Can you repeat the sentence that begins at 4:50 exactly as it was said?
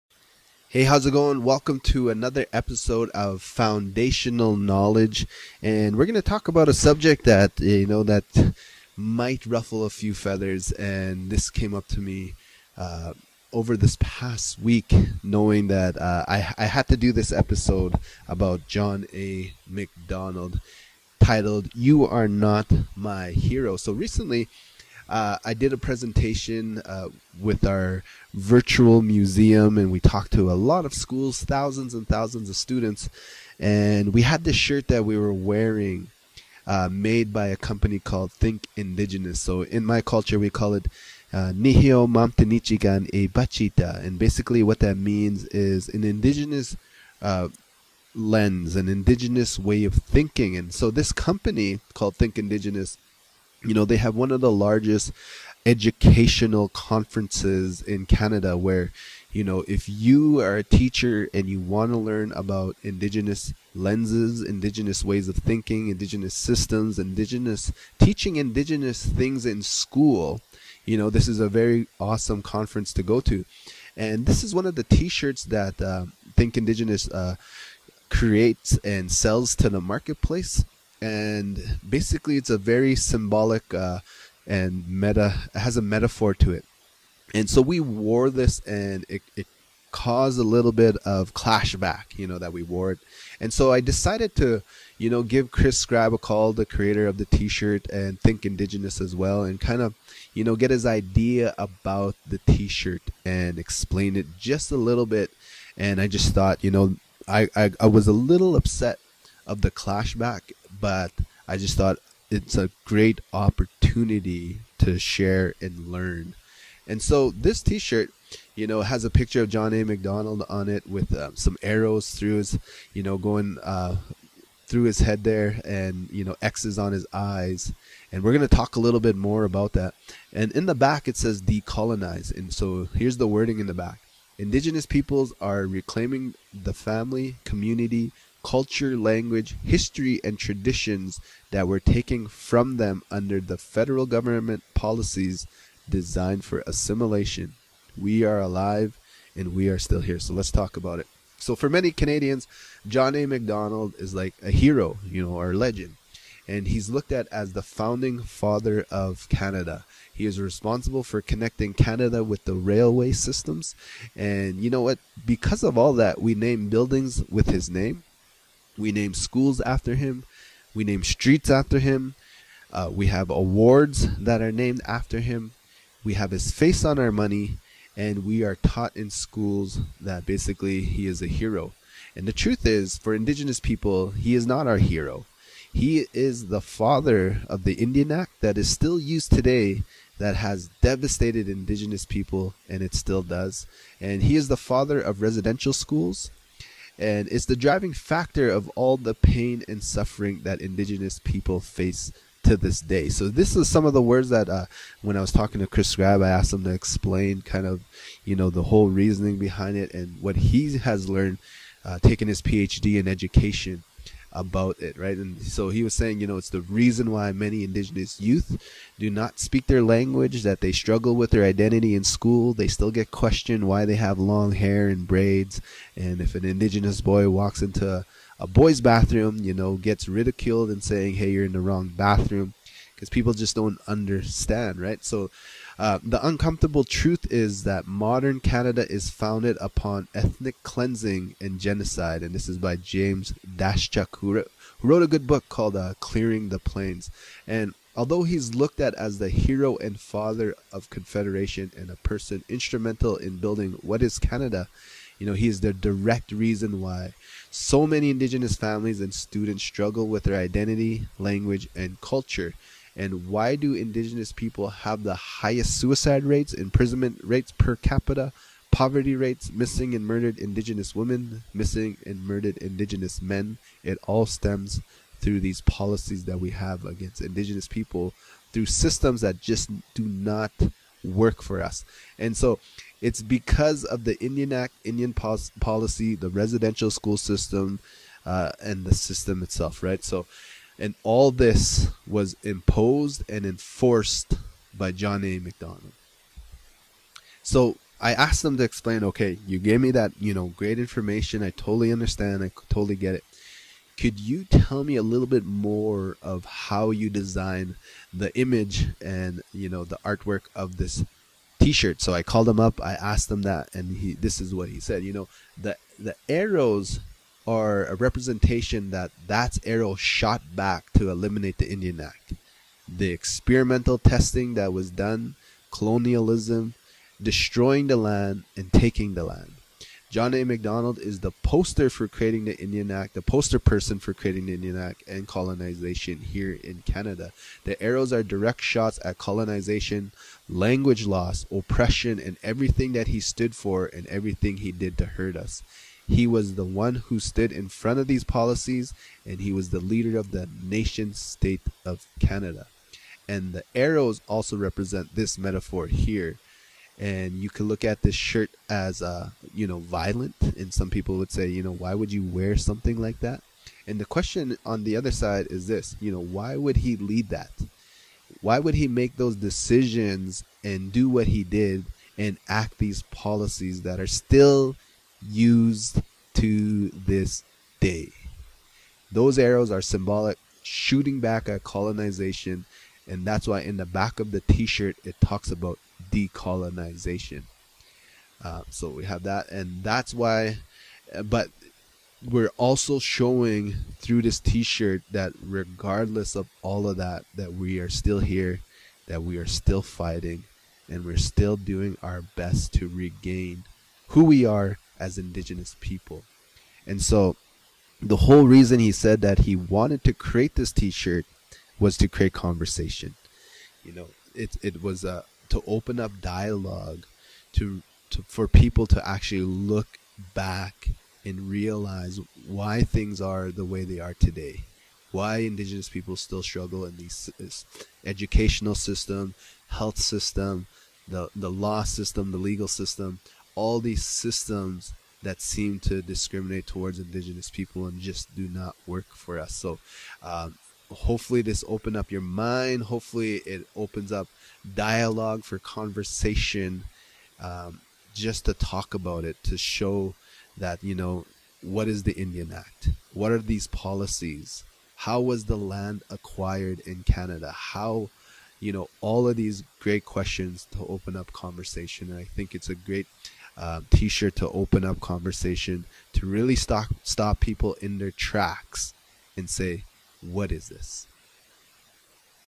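So and all this was imposed and enforced by John A.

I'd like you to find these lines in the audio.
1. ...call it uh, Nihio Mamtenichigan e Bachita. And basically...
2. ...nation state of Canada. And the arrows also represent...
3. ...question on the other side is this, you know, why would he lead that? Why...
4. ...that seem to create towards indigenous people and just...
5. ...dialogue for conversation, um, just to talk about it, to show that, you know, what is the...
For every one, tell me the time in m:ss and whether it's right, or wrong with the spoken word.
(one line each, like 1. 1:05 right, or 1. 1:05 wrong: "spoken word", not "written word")
1. 0:40 right
2. 5:50 right
3. 6:04 right
4. 7:15 wrong: "discriminate", not "create"
5. 7:24 right.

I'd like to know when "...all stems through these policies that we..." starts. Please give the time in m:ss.
4:34.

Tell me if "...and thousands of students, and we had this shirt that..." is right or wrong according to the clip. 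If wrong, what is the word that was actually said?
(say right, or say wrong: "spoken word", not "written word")
right.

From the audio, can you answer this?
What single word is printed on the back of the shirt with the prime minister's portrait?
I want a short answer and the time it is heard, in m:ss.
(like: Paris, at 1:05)
Decolonize, at 2:11.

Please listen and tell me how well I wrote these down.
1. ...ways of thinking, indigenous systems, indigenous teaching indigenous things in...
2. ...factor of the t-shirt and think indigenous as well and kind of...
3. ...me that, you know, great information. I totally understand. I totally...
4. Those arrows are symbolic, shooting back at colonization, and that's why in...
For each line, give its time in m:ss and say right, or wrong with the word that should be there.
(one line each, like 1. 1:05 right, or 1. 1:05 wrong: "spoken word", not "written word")
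1. 1:05 right
2. 1:36 wrong: "creator", not "factor"
3. 4:59 right
4. 6:19 right.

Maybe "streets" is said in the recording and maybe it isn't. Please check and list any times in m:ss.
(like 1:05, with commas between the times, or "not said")
2:51.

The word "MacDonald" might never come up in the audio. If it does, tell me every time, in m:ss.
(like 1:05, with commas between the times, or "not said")
0:19, 1:59, 2:33, 4:55, 5:30.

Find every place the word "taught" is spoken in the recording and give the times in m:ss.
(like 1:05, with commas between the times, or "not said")
2:58.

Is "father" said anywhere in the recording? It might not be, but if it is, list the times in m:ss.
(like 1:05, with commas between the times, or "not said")
2:38, 3:06, 3:14, 4:09.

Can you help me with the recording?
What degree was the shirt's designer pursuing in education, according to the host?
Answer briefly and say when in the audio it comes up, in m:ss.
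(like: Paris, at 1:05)
PhD, at 3:32.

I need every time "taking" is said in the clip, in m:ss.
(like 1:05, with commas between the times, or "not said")
3:32, 5:28.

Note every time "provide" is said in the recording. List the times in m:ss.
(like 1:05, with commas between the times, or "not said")
not said.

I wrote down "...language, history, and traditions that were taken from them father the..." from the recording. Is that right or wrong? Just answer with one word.
wrong.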